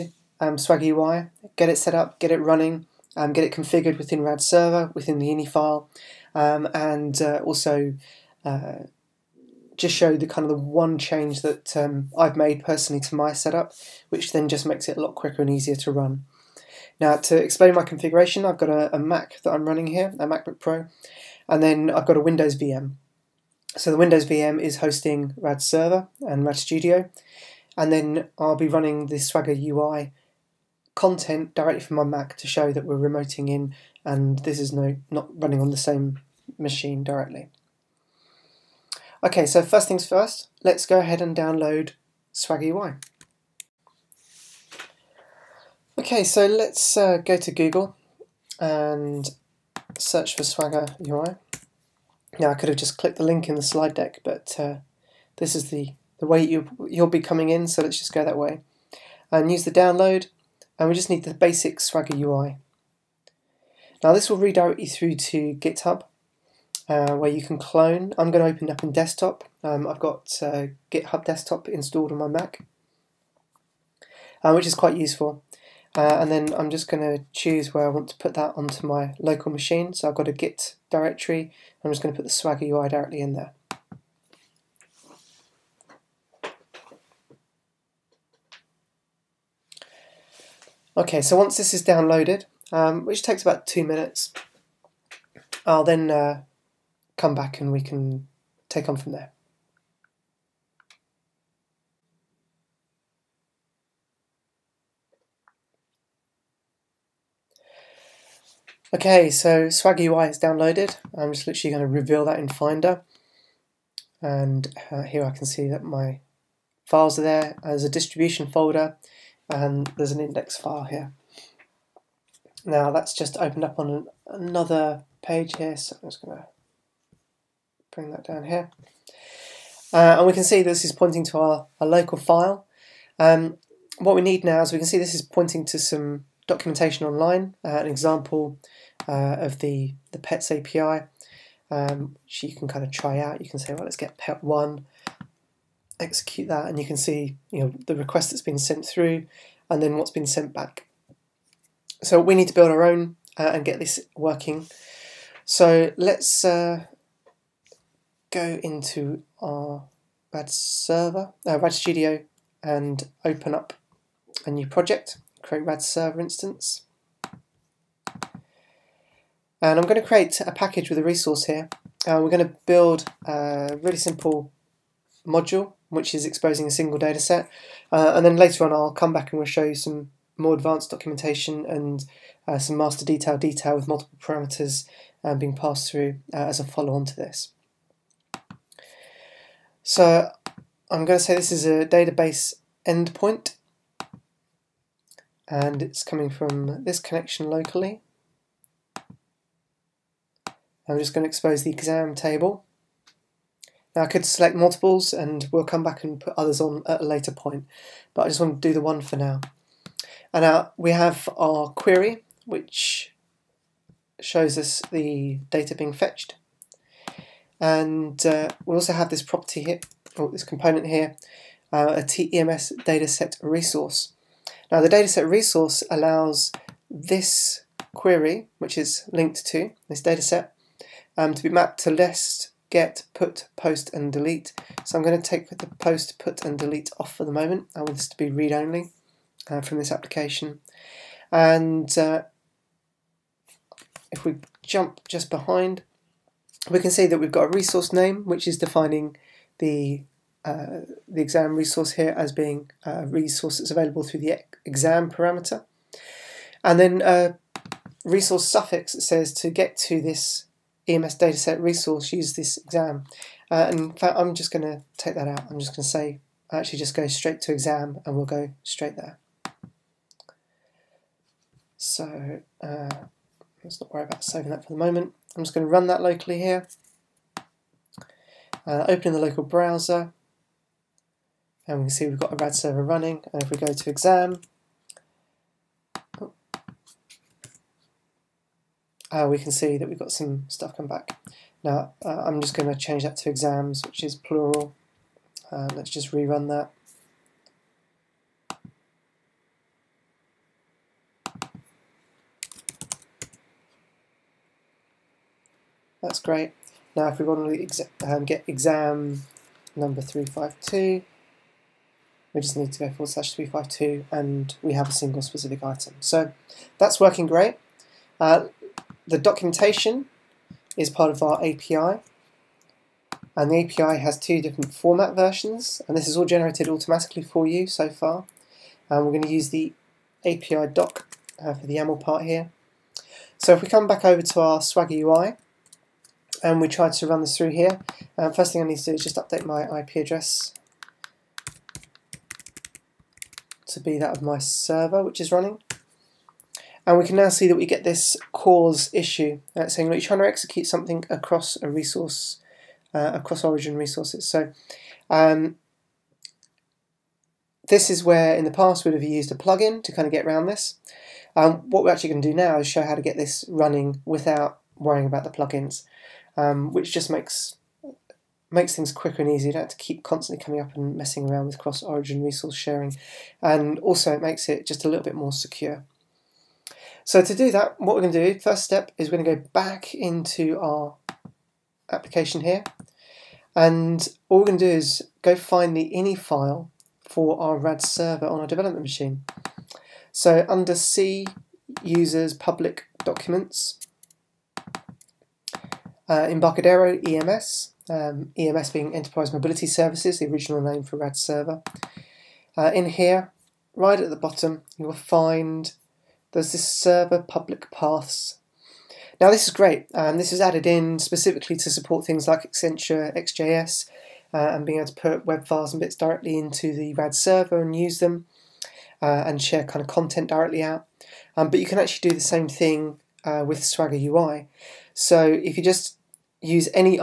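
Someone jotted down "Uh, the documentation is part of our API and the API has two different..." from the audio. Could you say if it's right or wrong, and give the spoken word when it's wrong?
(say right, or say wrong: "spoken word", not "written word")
right.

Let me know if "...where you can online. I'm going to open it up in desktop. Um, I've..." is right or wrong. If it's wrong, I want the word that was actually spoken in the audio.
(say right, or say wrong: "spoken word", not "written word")
wrong: "clone", not "online".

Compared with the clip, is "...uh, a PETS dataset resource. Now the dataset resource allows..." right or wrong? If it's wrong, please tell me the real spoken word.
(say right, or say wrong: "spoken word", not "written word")
wrong: "TEMS", not "PETS".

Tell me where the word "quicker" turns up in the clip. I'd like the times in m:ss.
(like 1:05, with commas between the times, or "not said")
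0:15, 6:08.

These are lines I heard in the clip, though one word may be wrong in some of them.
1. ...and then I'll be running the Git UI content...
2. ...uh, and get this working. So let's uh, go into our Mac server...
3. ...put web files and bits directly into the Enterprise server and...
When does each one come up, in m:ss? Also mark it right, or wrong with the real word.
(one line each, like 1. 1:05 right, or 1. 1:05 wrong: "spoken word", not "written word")
1. 0:27 wrong: "Swagger", not "Git"
2. 2:33 wrong: "RAD", not "Mac"
3. 6:54 wrong: "RAD", not "Enterprise".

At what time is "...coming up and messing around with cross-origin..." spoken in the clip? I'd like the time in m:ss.
6:10.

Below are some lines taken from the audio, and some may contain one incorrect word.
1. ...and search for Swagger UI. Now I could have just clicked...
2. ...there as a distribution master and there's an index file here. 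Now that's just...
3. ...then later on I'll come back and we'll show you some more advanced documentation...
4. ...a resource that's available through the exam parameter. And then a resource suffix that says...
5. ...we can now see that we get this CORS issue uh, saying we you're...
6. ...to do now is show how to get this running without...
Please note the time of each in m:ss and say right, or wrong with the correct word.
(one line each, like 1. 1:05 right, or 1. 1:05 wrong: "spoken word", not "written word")
1. 0:48 right
2. 1:57 wrong: "folder", not "master"
3. 2:58 right
4. 4:12 right
5. 5:46 right
6. 6:02 right.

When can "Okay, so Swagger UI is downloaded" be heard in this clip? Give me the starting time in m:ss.
1:48.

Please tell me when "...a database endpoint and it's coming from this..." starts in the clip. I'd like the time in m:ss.
3:11.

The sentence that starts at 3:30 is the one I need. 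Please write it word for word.
And now we have our query, which shows us the data being fetched.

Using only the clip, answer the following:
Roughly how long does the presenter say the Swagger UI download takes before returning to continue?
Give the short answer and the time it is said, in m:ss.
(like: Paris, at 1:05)
two minutes, at 1:33.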